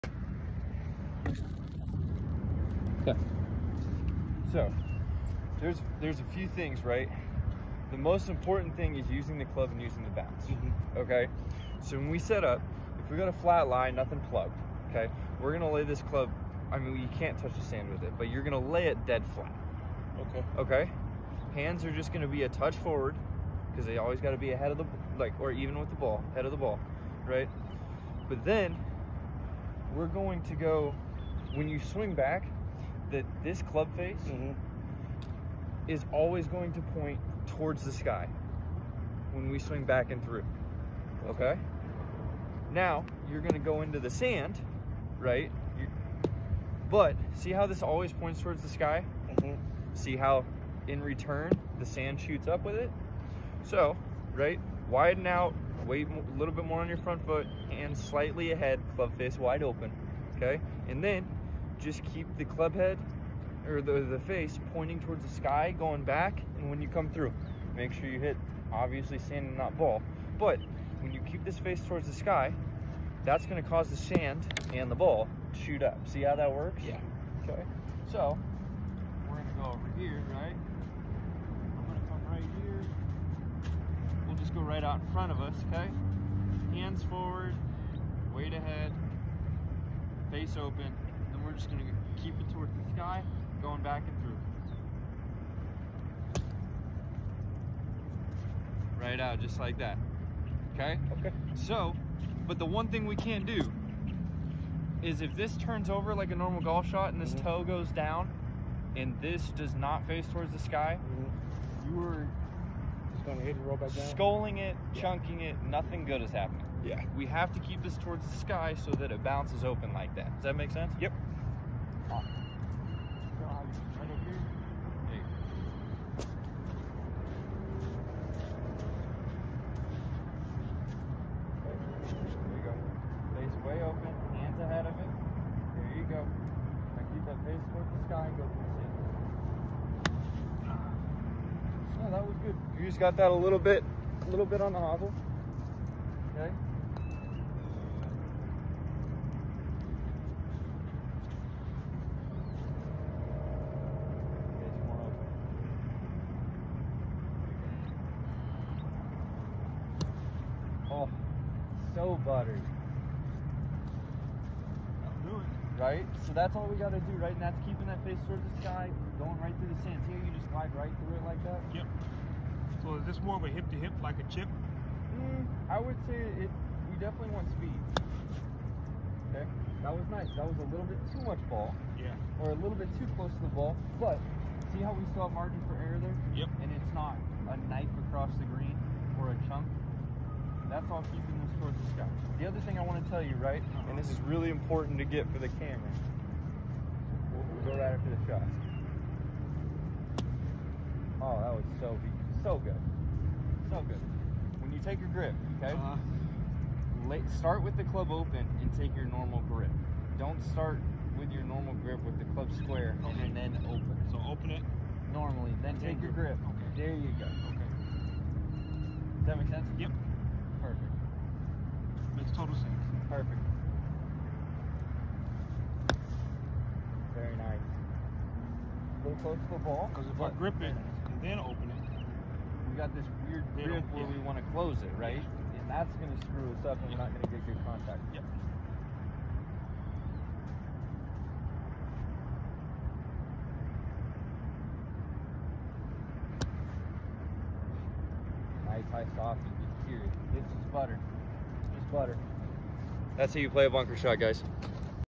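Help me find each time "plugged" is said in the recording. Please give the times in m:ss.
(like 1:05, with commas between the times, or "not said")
0:14.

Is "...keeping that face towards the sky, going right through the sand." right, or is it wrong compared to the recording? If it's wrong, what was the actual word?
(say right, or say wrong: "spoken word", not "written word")
right.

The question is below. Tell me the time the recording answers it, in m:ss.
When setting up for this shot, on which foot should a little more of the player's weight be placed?
0:57.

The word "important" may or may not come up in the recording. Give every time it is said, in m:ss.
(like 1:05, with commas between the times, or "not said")
0:08, 3:14.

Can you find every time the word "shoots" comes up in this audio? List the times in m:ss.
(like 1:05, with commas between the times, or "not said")
0:52, 1:15.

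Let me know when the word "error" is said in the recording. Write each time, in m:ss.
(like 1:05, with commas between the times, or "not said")
3:05.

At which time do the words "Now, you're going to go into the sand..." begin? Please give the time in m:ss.
0:42.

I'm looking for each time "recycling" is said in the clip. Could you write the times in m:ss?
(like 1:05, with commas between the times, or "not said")
not said.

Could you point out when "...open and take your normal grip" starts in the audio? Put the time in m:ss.
3:28.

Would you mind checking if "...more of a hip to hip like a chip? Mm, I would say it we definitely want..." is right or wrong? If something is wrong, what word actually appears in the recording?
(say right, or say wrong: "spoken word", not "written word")
right.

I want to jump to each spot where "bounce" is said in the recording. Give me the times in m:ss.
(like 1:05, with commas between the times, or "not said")
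0:10, 1:59.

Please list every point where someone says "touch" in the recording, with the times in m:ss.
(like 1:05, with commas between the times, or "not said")
0:17, 0:22.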